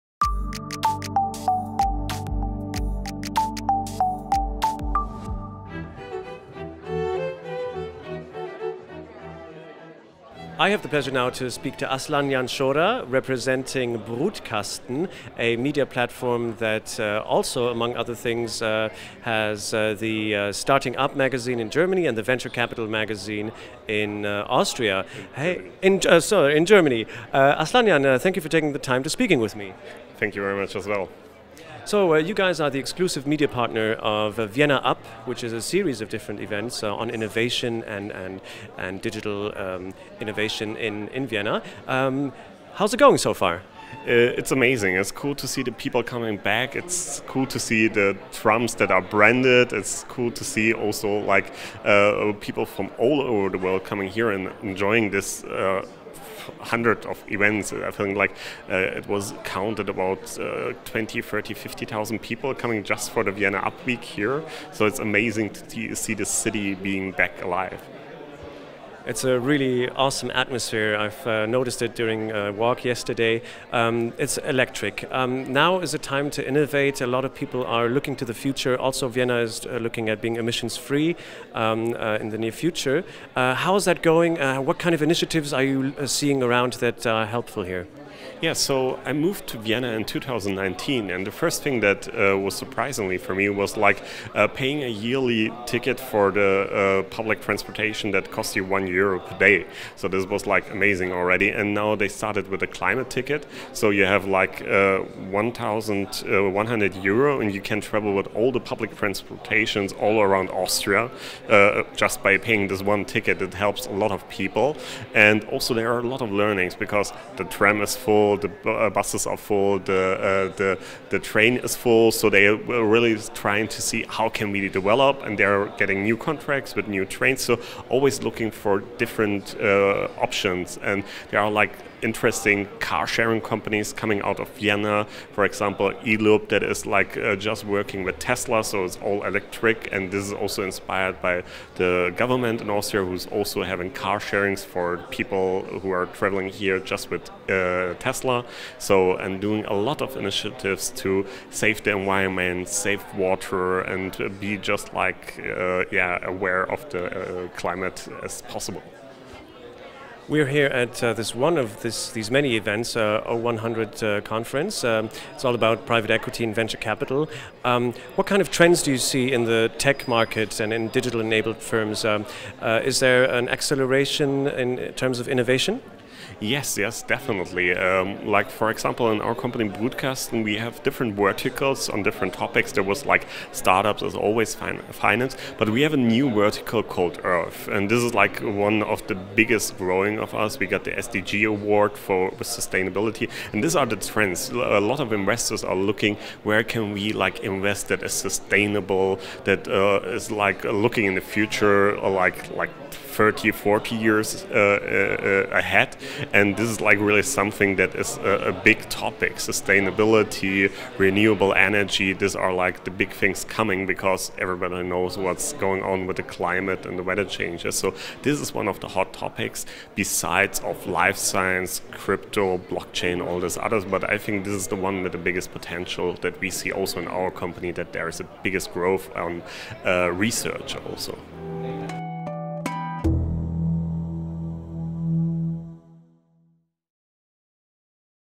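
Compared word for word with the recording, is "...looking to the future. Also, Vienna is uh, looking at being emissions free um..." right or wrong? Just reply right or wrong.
right.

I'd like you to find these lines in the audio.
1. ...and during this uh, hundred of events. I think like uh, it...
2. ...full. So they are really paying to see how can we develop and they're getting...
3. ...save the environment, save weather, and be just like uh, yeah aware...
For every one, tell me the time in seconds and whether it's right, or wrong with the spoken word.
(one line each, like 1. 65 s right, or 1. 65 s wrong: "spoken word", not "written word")
1. 54 s wrong: "enjoying", not "during"
2. 121 s wrong: "trying", not "paying"
3. 151 s wrong: "water", not "weather".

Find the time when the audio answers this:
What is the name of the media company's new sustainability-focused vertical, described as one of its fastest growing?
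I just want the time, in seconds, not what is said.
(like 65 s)
187 s.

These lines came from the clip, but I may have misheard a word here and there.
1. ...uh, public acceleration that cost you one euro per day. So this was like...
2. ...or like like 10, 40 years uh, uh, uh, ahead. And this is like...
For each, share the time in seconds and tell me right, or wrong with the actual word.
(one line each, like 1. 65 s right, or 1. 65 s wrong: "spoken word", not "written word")
1. 97 s wrong: "transportation", not "acceleration"
2. 201 s wrong: "30", not "10".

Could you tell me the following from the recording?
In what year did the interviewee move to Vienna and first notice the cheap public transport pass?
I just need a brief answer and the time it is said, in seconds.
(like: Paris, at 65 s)
2019, at 90 s.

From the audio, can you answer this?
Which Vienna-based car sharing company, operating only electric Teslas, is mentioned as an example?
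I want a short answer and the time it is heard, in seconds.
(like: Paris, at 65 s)
eLoop, at 136 s.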